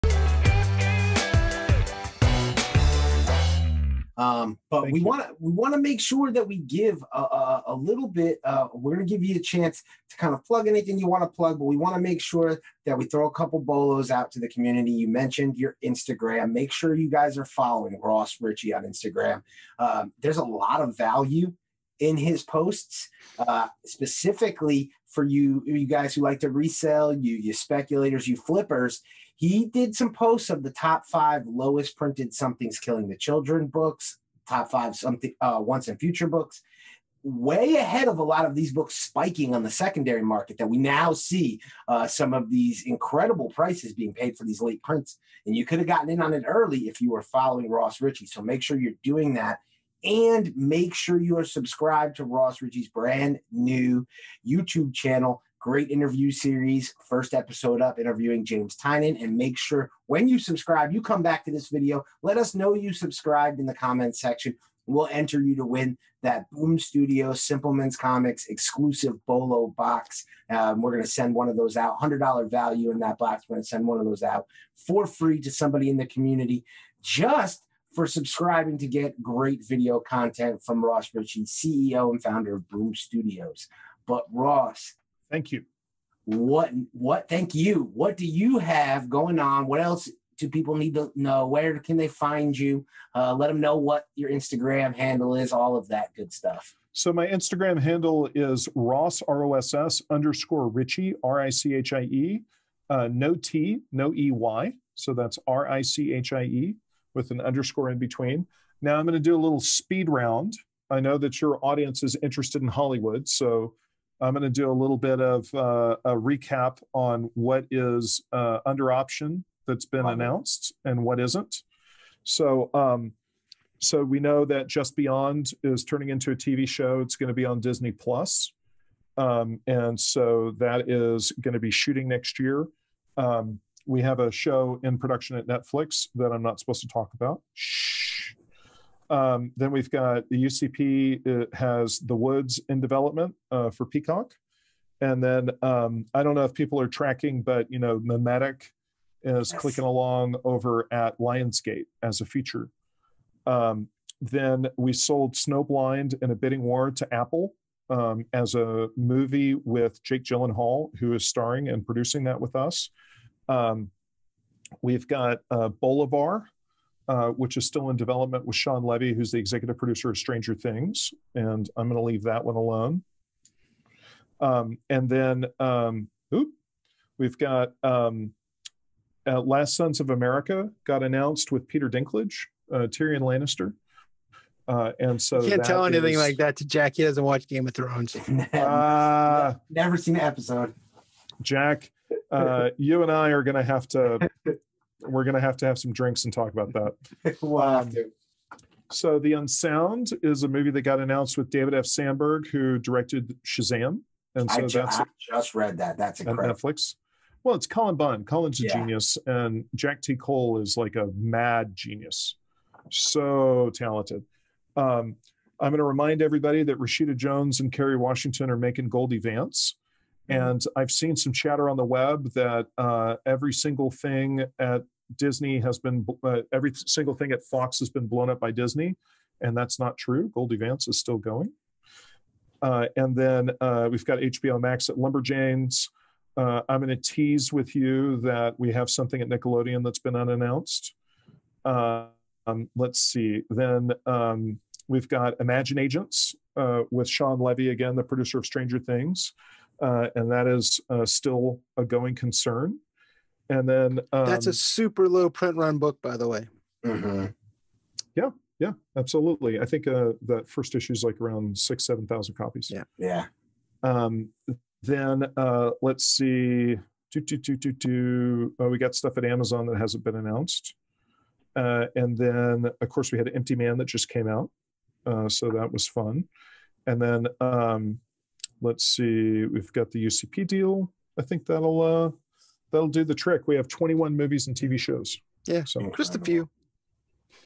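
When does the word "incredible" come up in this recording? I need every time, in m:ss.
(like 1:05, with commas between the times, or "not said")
0:42, 3:26.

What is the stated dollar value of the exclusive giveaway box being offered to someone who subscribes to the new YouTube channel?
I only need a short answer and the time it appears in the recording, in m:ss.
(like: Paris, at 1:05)
$100, at 1:11.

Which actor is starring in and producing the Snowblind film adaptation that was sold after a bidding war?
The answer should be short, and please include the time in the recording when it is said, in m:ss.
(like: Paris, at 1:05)
Jake Gyllenhaal, at 2:40.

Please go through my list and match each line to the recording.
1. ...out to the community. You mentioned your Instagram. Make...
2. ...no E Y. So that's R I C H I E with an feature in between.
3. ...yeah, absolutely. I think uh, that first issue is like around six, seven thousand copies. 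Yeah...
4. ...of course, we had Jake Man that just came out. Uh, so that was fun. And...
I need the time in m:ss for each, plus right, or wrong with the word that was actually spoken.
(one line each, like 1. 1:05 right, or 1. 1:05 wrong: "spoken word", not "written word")
1. 0:14 right
2. 1:43 wrong: "underscore", not "feature"
3. 4:18 right
4. 4:32 wrong: "Empty", not "Jake".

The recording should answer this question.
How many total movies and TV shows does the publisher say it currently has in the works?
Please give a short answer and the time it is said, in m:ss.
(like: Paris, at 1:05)
21, at 4:43.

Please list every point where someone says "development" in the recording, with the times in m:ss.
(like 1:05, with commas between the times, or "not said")
2:22, 2:47.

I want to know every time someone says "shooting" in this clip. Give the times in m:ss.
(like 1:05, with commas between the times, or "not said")
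2:11.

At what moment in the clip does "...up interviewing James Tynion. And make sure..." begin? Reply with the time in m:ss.
0:57.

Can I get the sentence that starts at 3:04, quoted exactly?
Uh, and so you can't tell anything is...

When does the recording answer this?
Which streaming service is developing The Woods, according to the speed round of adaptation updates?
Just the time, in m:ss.
2:23.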